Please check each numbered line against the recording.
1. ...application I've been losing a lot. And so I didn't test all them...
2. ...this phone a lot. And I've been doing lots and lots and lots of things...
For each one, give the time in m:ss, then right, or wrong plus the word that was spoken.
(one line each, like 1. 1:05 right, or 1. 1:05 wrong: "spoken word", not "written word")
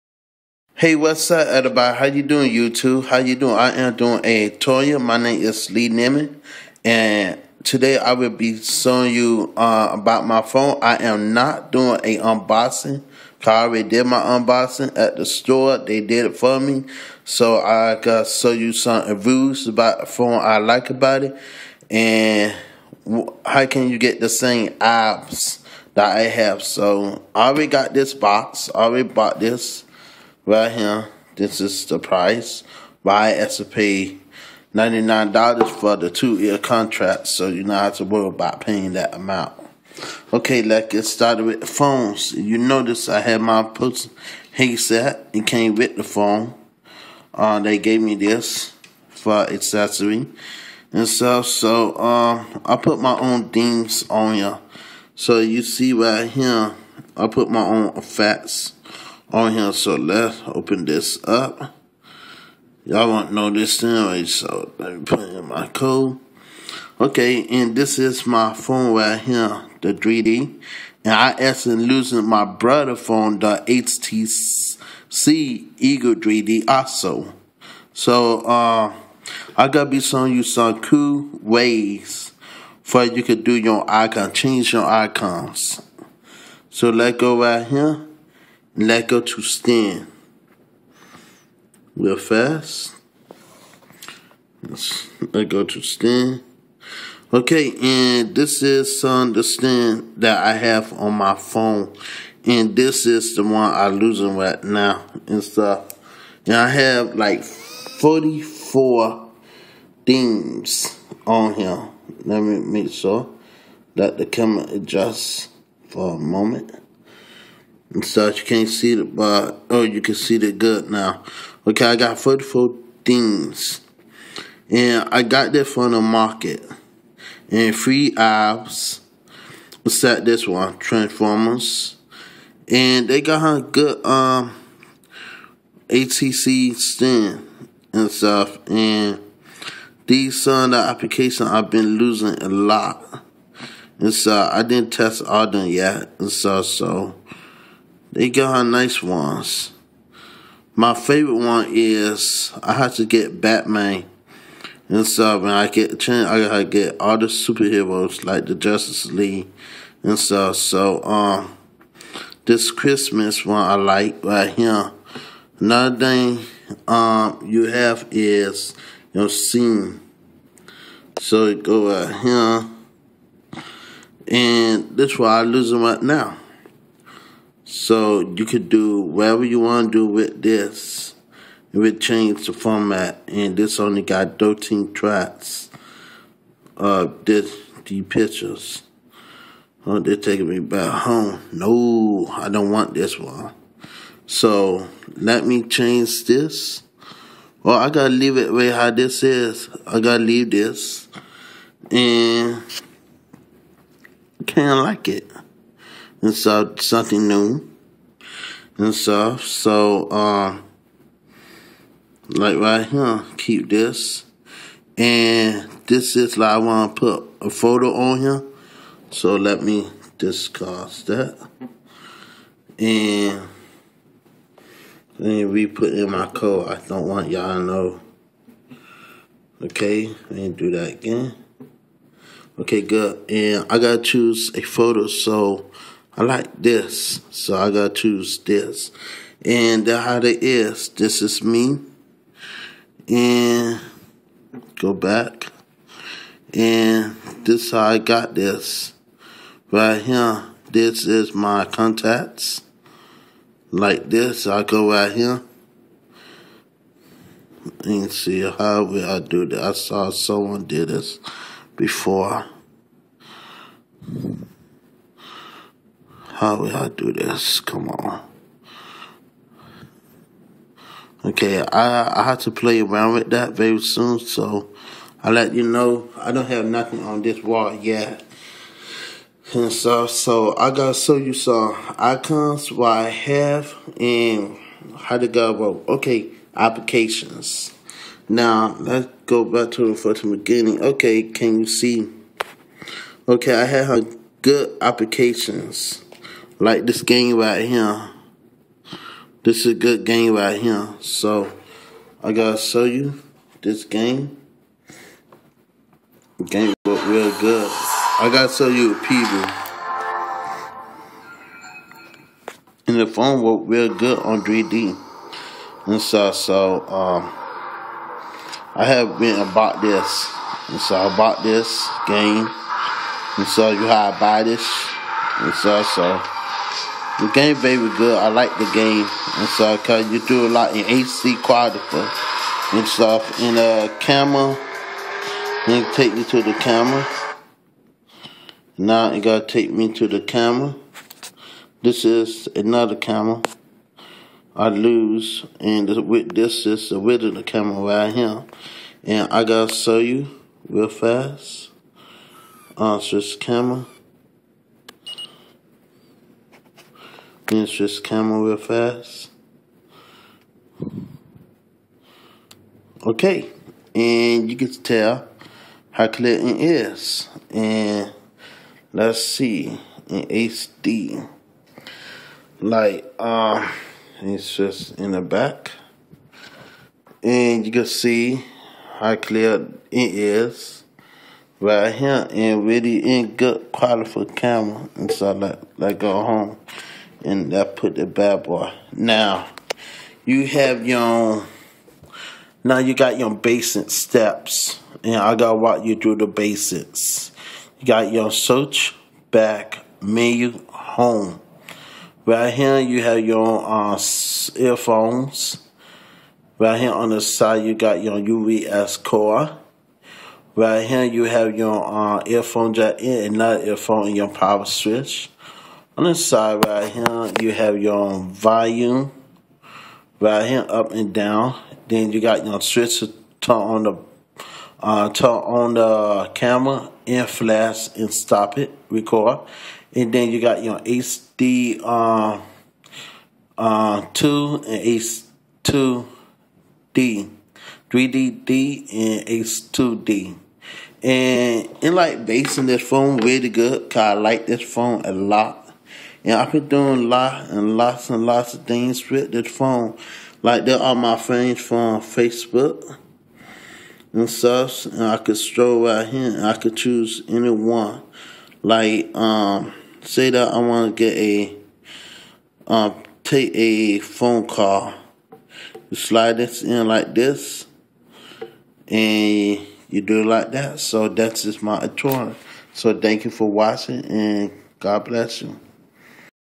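1. 2:20 right
2. 7:24 right.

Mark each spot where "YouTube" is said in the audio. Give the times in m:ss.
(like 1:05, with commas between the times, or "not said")
0:02.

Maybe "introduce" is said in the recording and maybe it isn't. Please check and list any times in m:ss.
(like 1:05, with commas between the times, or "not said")
not said.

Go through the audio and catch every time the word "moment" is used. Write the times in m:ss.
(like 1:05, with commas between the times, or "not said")
1:56.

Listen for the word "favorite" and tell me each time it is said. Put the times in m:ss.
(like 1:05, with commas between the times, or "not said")
2:30.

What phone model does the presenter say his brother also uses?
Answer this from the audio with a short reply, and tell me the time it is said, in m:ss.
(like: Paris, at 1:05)
HTC Evo 3D, at 1:13.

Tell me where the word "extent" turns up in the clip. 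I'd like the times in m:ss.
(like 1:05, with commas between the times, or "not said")
not said.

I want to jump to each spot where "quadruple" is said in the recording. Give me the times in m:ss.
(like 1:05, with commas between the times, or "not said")
5:31.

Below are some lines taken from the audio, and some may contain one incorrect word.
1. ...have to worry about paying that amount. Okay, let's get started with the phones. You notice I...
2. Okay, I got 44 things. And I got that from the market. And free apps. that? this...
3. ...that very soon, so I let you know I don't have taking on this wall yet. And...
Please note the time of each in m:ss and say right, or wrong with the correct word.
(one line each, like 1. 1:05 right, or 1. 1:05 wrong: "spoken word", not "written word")
1. 0:37 right
2. 2:01 right
3. 4:33 wrong: "nothing", not "taking".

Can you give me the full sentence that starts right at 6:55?
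On this side right here, you have your volume right here, up and down.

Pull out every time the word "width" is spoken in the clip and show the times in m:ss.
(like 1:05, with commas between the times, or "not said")
5:46.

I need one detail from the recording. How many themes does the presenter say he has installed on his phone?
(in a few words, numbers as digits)
44.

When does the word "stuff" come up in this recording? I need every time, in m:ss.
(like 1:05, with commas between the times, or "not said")
0:51, 1:45, 2:18, 2:35, 2:40, 3:28, 5:32, 7:34.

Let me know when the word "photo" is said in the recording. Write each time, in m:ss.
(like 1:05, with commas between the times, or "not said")
3:37, 3:54.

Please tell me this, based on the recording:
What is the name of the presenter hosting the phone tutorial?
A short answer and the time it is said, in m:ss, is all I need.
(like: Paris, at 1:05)
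Lee Neiman, at 0:05.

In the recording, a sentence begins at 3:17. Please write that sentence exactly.
Well, I gotta leave it way how this is.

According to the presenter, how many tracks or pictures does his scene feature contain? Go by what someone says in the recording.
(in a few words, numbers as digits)
13.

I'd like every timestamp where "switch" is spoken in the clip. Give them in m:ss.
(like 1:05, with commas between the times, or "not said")
6:54, 7:02.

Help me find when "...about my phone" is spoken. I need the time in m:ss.
0:09.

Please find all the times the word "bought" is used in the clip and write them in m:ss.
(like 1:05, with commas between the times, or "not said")
0:29, 5:21.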